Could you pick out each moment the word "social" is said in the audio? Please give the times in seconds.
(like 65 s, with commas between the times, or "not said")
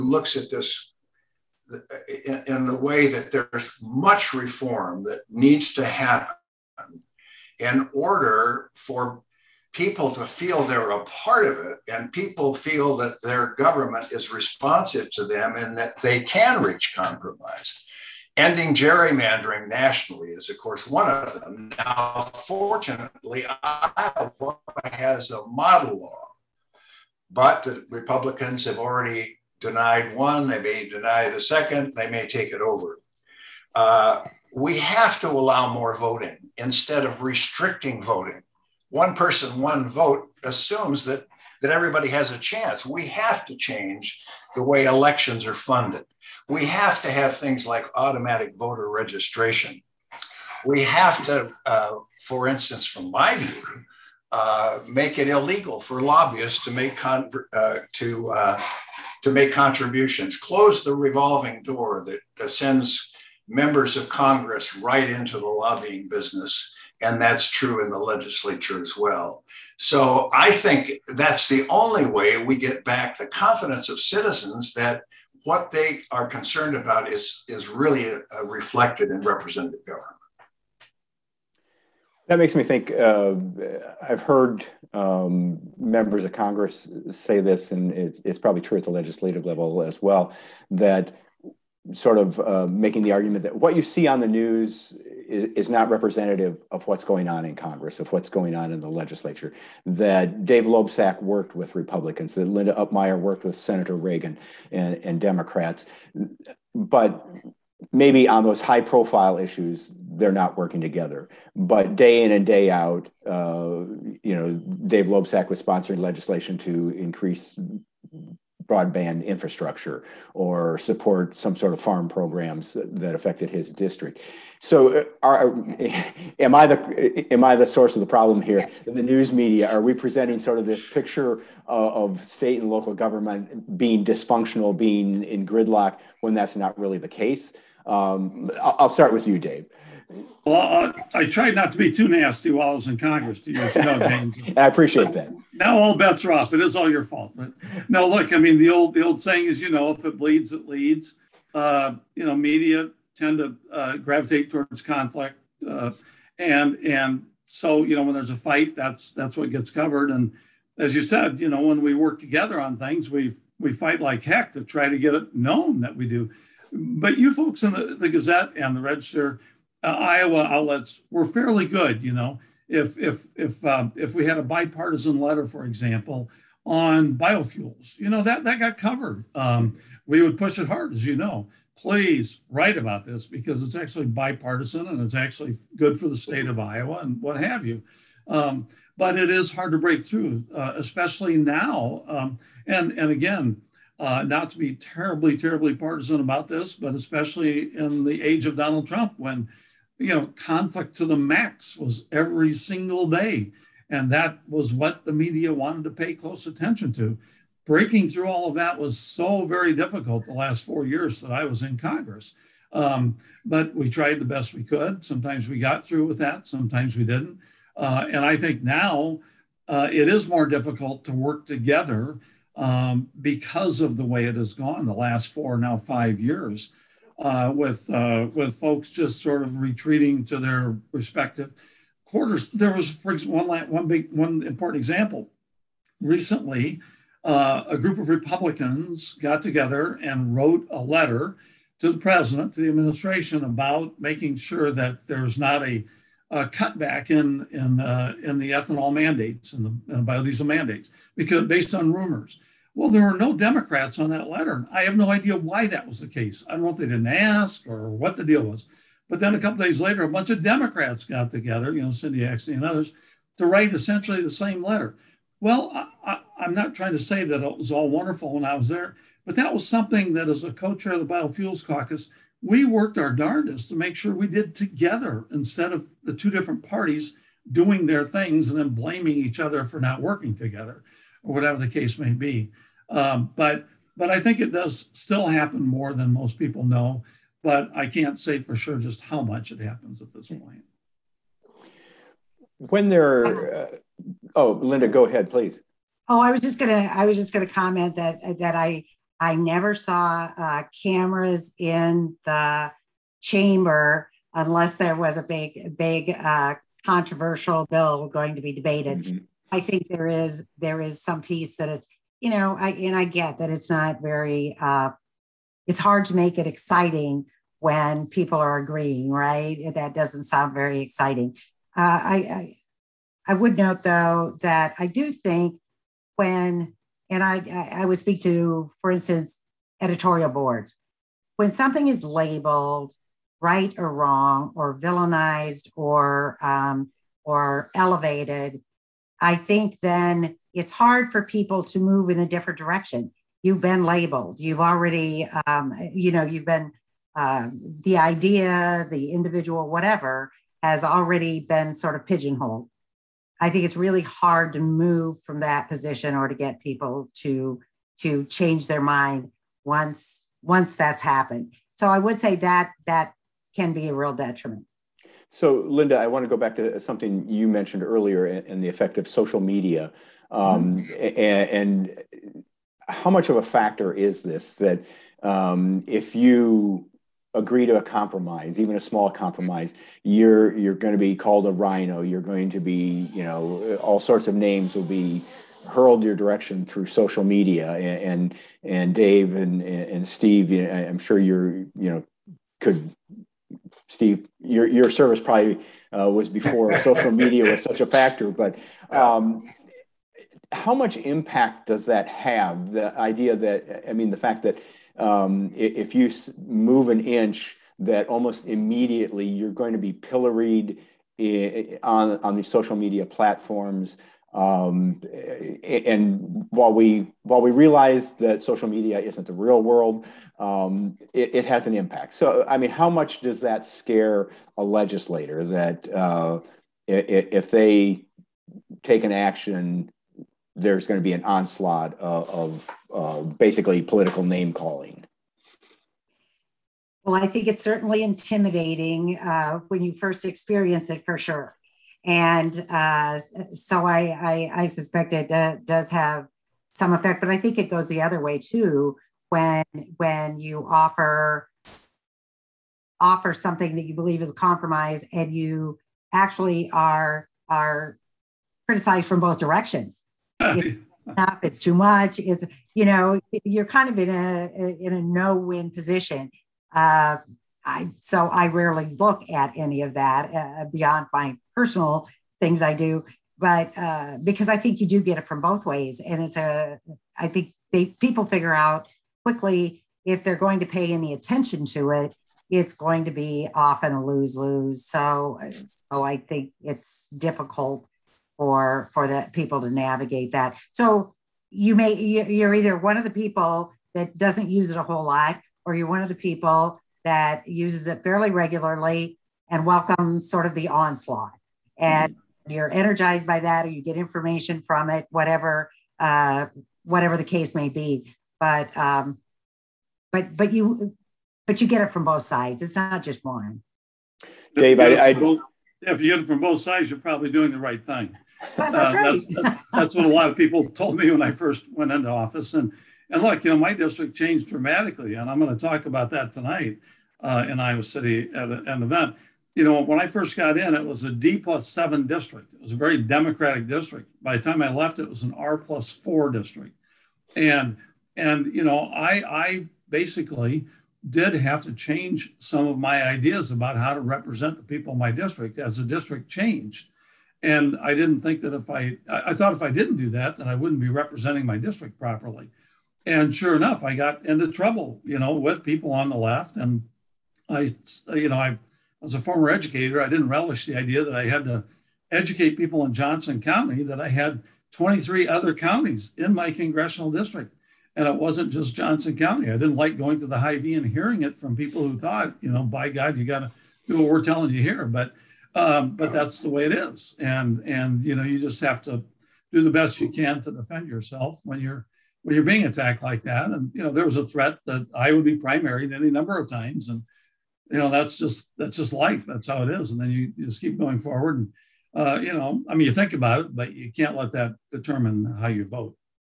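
369 s, 386 s, 396 s, 412 s, 418 s.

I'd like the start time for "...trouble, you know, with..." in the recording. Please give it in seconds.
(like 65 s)
554 s.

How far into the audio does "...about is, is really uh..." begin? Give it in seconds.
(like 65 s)
76 s.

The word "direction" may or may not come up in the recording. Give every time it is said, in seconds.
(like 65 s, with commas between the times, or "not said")
342 s, 386 s, 459 s.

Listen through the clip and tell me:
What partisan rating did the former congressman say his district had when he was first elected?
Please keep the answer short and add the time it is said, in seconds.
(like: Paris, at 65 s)
D+7, at 531 s.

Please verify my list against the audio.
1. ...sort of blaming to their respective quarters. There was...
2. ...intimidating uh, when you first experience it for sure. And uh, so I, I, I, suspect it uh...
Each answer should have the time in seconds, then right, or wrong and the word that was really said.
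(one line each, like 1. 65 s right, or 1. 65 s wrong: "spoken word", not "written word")
1. 229 s wrong: "retreating", not "blaming"
2. 438 s right.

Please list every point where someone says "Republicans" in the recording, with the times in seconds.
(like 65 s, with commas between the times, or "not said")
27 s, 101 s, 238 s.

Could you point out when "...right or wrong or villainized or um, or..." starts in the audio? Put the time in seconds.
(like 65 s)
333 s.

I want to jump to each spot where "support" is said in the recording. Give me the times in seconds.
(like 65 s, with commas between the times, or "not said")
120 s.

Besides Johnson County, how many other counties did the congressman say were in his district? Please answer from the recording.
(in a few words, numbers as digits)
23.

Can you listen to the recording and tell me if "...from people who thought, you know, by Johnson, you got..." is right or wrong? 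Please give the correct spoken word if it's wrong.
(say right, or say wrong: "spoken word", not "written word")
wrong: "God", not "Johnson".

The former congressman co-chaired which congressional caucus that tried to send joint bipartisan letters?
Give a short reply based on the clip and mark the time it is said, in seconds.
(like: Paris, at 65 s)
Biofuels Caucus, at 271 s.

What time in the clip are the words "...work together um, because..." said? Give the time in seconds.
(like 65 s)
221 s.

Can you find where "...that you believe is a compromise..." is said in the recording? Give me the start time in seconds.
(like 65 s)
453 s.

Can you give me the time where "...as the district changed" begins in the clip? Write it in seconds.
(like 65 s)
545 s.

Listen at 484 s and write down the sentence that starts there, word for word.
So, uh, so I think it's difficult for for the people to navigate that.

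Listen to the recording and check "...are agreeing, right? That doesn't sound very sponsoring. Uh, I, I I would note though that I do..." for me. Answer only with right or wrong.
wrong.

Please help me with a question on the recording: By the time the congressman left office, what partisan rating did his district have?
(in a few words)
R+4.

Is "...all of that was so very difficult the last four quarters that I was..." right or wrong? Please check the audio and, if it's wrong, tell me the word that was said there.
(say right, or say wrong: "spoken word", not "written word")
wrong: "years", not "quarters".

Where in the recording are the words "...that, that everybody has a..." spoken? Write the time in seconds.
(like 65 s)
41 s.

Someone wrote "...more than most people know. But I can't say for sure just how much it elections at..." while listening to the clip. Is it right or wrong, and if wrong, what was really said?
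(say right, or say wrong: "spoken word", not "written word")
wrong: "happens", not "elections".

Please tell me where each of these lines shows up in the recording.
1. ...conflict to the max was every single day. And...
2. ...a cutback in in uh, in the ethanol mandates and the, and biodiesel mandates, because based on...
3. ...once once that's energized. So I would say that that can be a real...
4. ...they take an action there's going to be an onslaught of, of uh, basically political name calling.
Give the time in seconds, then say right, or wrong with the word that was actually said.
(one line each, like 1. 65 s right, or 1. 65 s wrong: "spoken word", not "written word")
1. 200 s right
2. 246 s right
3. 359 s wrong: "happened", not "energized"
4. 427 s right.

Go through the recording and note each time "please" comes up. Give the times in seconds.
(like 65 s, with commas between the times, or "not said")
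181 s, 295 s.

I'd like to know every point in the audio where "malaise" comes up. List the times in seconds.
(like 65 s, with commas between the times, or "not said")
not said.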